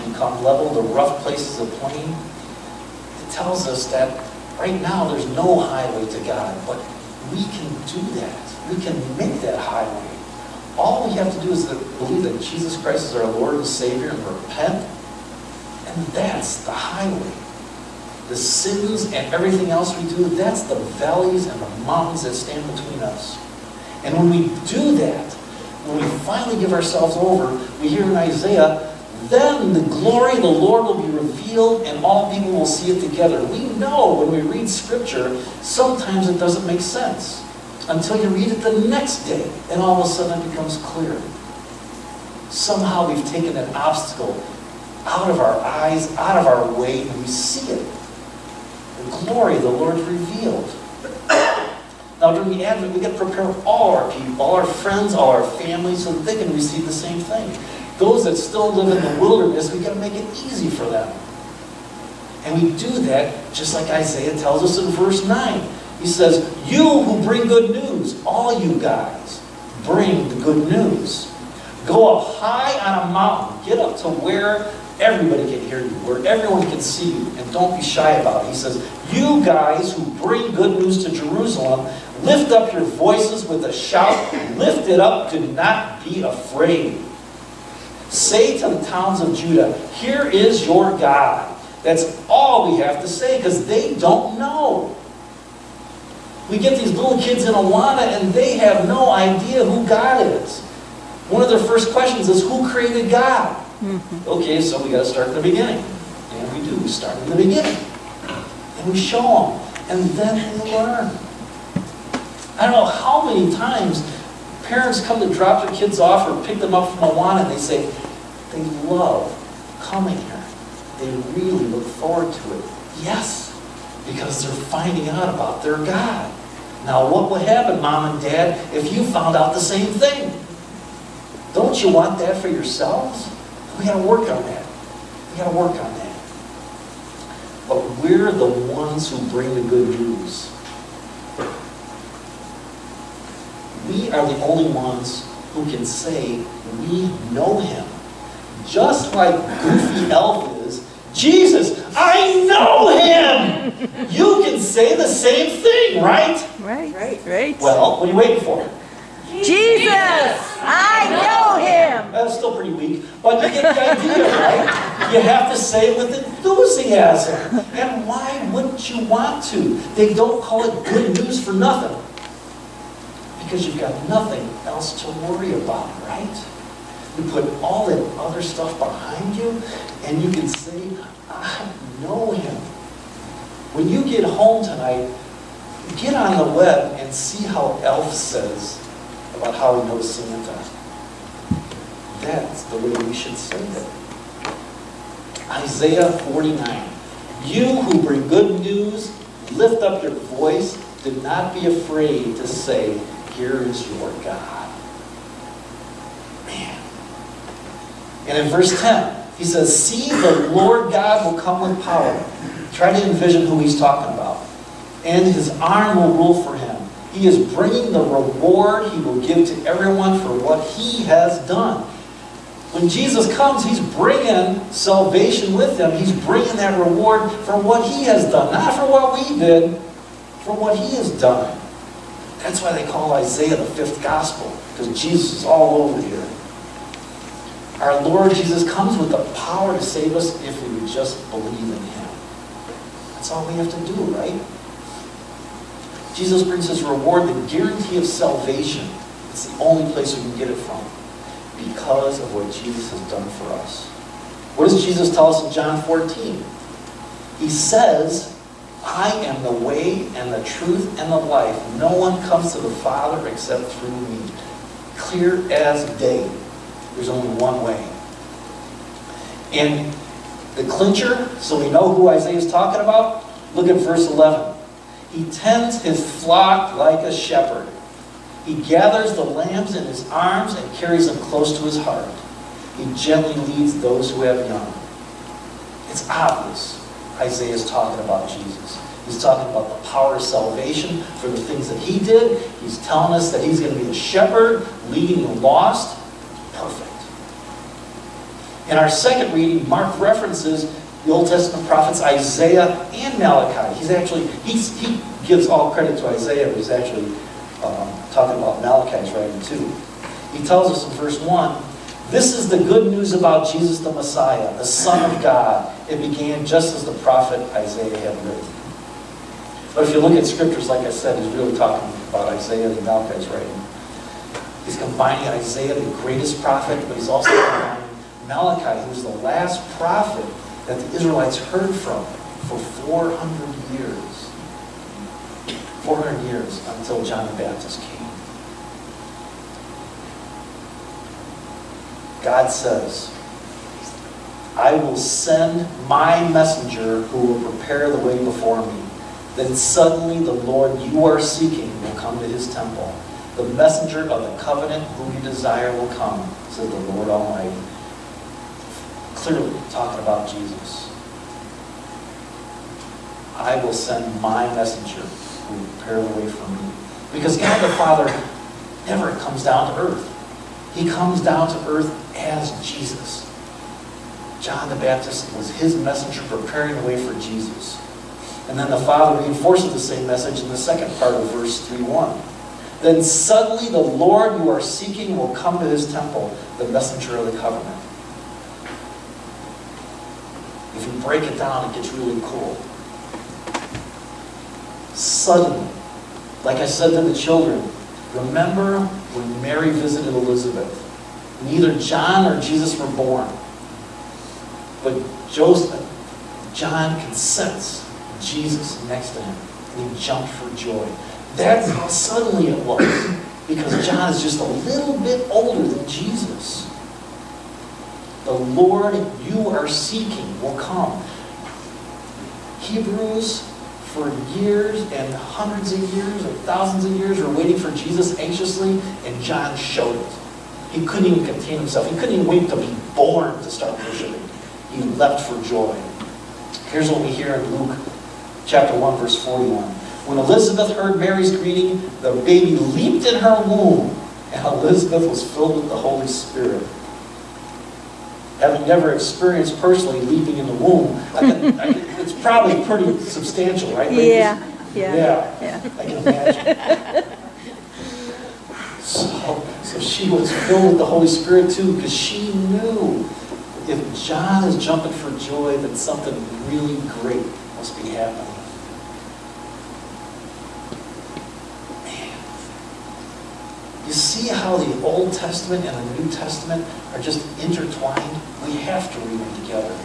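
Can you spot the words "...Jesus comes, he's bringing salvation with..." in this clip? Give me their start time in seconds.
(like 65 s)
222 s.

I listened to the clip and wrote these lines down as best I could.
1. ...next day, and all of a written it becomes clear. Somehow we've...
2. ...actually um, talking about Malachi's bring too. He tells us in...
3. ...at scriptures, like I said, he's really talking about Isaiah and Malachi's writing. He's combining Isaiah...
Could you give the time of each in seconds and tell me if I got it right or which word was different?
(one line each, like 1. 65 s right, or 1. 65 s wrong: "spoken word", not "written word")
1. 38 s wrong: "sudden", not "written"
2. 306 s wrong: "writing", not "bring"
3. 320 s right.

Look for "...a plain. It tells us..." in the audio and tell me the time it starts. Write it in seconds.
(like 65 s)
1 s.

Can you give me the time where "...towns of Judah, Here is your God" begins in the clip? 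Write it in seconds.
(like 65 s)
88 s.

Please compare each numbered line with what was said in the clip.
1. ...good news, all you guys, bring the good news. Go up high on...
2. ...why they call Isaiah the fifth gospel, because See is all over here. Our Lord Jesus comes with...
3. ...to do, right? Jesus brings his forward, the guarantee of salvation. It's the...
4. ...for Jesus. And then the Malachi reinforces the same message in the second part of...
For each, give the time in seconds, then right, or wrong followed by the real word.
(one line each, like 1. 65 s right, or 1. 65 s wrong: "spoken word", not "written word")
1. 67 s right
2. 232 s wrong: "Jesus", not "See"
3. 243 s wrong: "reward", not "forward"
4. 377 s wrong: "Father", not "Malachi".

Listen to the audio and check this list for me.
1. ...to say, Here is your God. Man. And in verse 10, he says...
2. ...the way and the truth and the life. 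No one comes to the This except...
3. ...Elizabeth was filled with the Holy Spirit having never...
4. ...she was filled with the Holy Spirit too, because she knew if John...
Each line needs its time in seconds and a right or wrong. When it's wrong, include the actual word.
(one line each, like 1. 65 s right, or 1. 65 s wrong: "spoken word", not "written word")
1. 202 s right
2. 259 s wrong: "Father", not "This"
3. 444 s right
4. 459 s right.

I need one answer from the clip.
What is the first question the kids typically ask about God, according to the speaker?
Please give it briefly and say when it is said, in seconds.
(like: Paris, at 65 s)
Who created God?, at 102 s.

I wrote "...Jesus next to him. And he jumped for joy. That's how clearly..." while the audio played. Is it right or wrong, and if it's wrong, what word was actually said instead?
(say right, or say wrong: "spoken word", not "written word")
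wrong: "suddenly", not "clearly".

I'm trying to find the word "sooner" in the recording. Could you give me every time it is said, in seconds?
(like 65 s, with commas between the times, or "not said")
not said.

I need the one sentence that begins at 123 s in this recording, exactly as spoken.
Yes, because they're finding out about their God.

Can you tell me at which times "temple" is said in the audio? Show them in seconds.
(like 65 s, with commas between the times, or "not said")
352 s, 385 s.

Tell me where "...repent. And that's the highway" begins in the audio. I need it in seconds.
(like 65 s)
14 s.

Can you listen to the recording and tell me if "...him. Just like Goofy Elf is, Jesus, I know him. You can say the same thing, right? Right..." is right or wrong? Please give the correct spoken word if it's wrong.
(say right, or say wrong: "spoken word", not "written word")
right.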